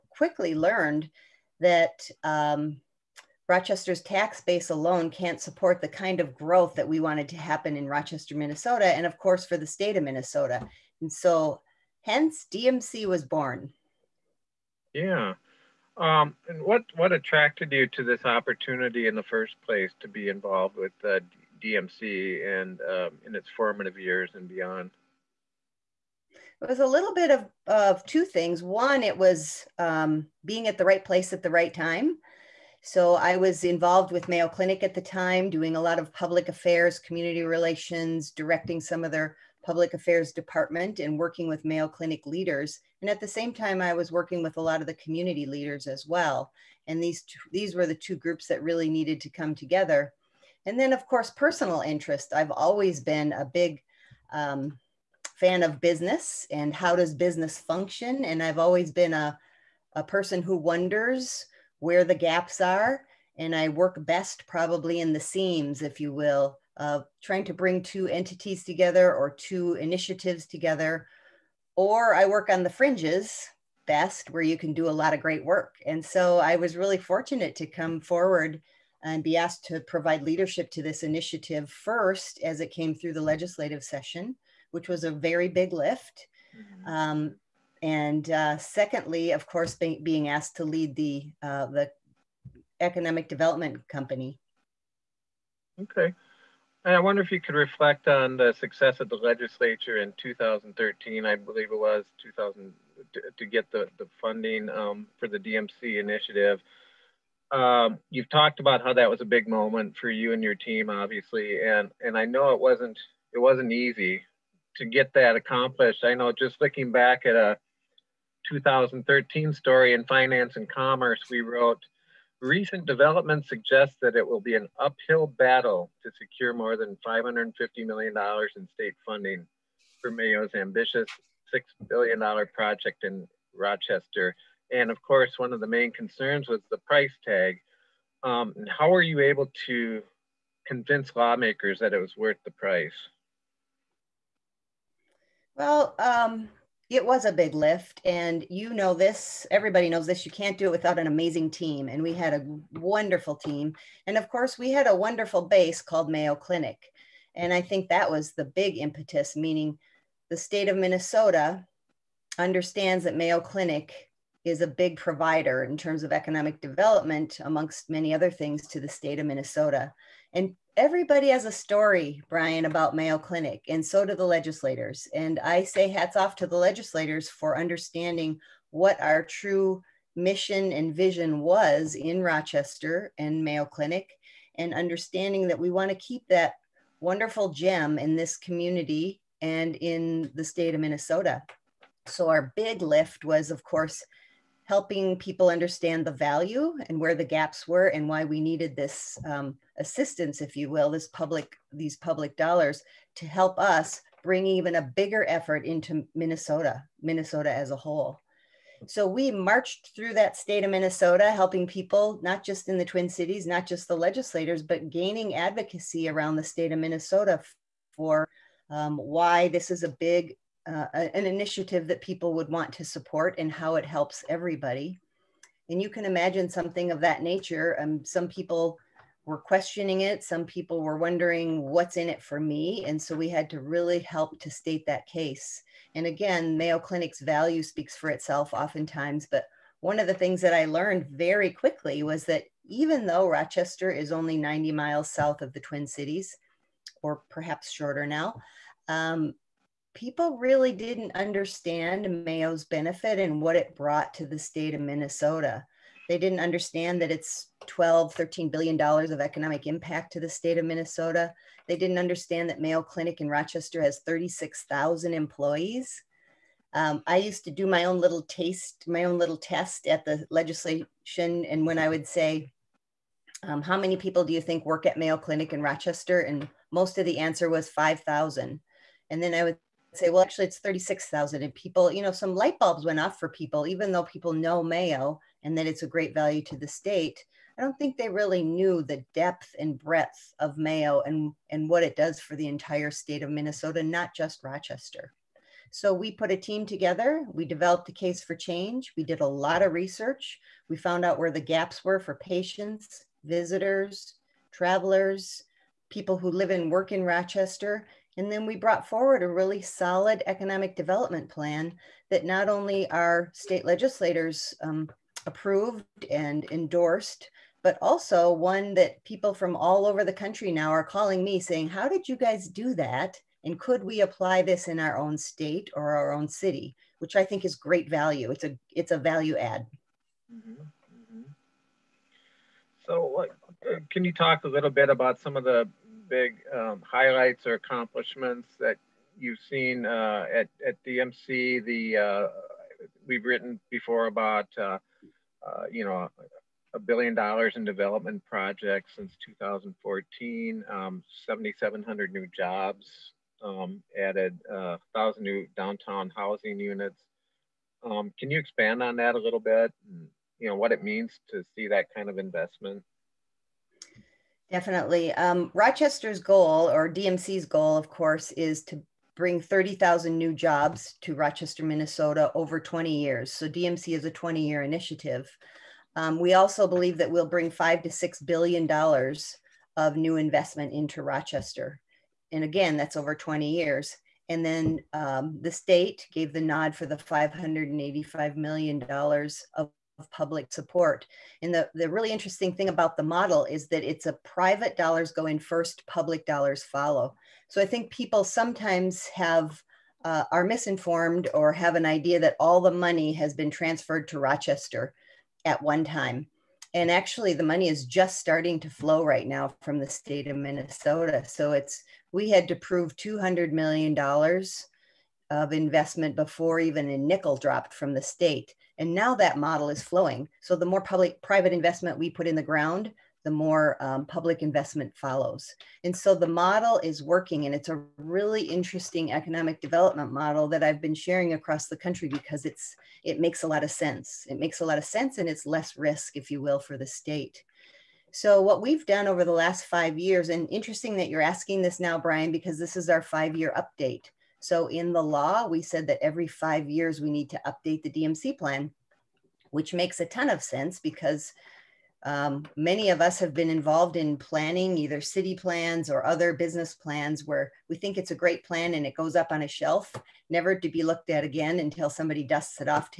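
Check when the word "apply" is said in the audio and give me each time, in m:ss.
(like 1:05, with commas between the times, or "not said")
5:23.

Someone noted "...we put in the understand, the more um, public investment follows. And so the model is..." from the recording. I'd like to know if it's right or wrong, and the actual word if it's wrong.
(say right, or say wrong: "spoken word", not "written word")
wrong: "ground", not "understand".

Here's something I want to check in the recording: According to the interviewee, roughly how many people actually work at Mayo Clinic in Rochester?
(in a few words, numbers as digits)
36,000.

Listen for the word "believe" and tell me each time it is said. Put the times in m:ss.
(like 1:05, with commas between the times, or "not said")
1:41, 6:16.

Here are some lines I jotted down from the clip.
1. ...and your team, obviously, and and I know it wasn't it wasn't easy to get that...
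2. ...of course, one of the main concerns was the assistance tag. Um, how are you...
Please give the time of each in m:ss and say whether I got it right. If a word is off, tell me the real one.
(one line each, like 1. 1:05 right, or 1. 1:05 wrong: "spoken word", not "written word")
1. 1:50 right
2. 2:14 wrong: "price", not "assistance".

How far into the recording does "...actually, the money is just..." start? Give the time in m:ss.
6:46.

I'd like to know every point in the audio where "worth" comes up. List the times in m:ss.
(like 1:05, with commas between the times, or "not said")
2:22.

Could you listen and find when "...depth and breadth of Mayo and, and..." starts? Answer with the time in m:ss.
4:49.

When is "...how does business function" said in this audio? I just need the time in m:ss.
0:56.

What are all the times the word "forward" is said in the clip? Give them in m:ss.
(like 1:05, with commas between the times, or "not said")
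1:17, 5:08.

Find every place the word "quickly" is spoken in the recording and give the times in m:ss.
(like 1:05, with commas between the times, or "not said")
0:00, 4:01.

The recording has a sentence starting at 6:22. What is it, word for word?
And again, that's over 20 years.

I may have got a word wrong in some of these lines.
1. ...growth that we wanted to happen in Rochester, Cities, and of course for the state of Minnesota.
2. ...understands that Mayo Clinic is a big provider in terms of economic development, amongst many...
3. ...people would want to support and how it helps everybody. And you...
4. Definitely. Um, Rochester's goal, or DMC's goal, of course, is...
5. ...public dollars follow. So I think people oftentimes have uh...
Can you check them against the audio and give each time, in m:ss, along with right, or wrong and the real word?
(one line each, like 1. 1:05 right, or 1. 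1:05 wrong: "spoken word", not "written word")
1. 0:06 wrong: "Minnesota", not "Cities"
2. 2:42 right
3. 3:42 right
4. 6:04 right
5. 6:35 wrong: "sometimes", not "oftentimes".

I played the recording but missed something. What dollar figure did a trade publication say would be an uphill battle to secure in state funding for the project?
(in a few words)
$550 million.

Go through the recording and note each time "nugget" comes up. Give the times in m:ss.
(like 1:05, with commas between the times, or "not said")
not said.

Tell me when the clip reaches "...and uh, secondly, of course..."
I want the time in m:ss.
1:27.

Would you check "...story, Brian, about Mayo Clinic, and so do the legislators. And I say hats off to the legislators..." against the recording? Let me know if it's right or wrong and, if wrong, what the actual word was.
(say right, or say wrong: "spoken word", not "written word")
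right.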